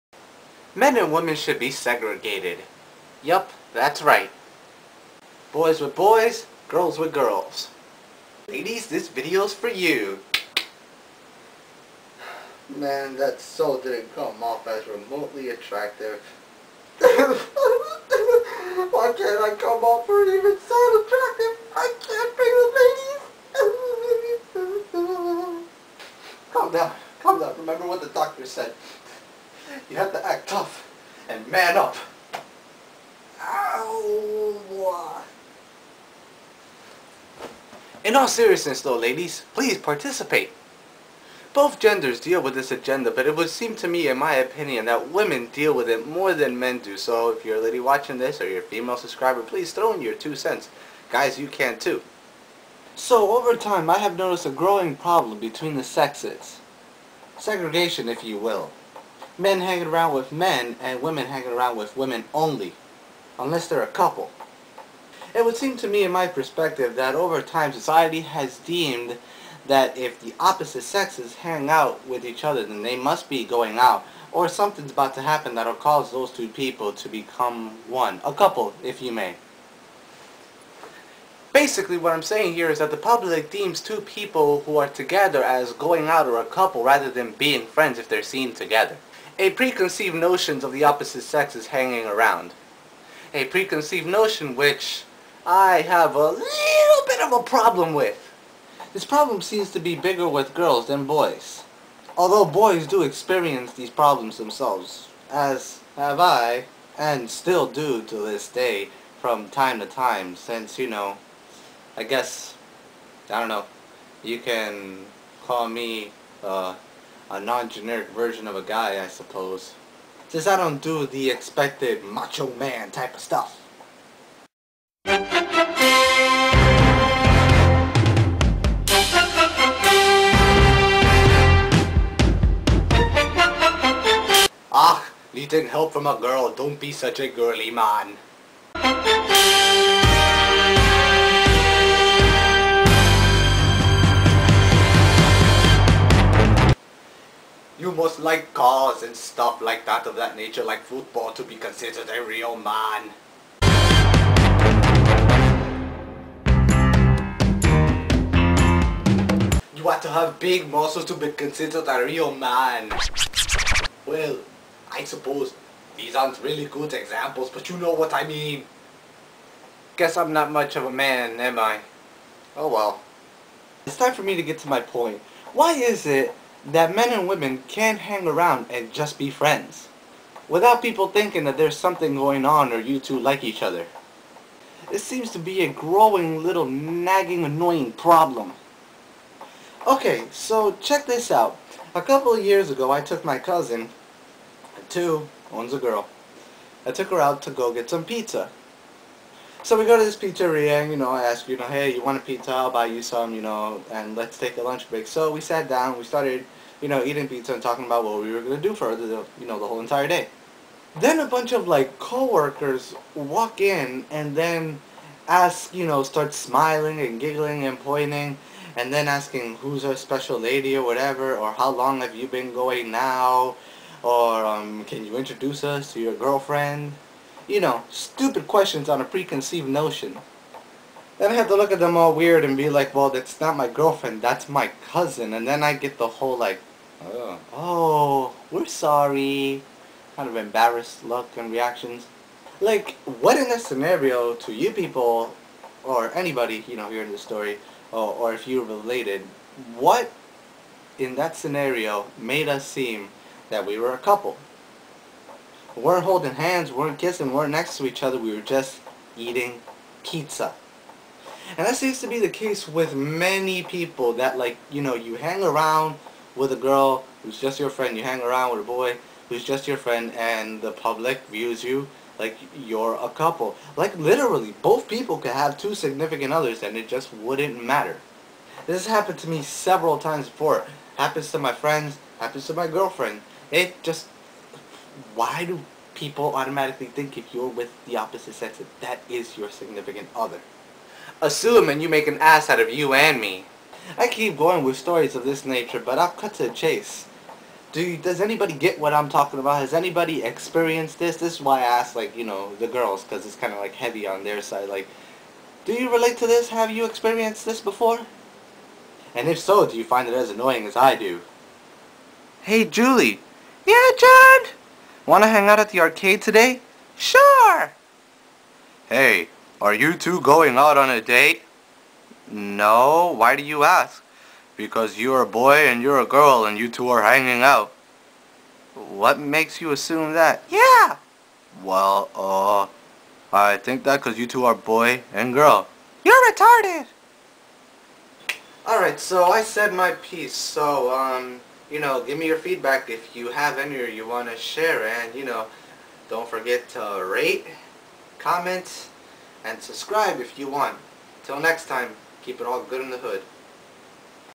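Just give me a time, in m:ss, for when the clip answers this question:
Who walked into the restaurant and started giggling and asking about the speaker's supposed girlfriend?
3:31.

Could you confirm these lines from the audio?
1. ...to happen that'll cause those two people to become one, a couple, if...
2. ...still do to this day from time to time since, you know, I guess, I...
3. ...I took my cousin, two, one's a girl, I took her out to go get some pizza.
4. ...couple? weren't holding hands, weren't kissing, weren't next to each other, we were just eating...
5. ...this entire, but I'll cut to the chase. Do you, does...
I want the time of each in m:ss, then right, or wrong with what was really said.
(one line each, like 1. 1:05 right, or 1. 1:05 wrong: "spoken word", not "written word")
1. 1:15 right
2. 1:47 right
3. 3:12 right
4. 4:13 right
5. 4:55 wrong: "nature", not "entire".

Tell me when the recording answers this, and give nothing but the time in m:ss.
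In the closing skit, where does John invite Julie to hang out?
5:15.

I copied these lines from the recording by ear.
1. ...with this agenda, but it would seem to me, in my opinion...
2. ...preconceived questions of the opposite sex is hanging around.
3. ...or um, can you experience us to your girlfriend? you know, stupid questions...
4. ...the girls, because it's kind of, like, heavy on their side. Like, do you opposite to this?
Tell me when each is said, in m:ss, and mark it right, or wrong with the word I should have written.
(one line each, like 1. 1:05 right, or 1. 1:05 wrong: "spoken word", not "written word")
1. 0:42 right
2. 1:29 wrong: "notions", not "questions"
3. 3:44 wrong: "introduce", not "experience"
4. 5:02 wrong: "relate", not "opposite".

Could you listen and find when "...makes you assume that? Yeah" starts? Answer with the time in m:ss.
5:29.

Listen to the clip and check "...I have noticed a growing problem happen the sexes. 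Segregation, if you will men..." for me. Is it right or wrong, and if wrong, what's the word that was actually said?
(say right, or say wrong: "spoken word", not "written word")
wrong: "between", not "happen".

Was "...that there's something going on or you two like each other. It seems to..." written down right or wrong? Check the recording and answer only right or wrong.
right.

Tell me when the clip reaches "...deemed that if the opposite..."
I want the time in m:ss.
1:08.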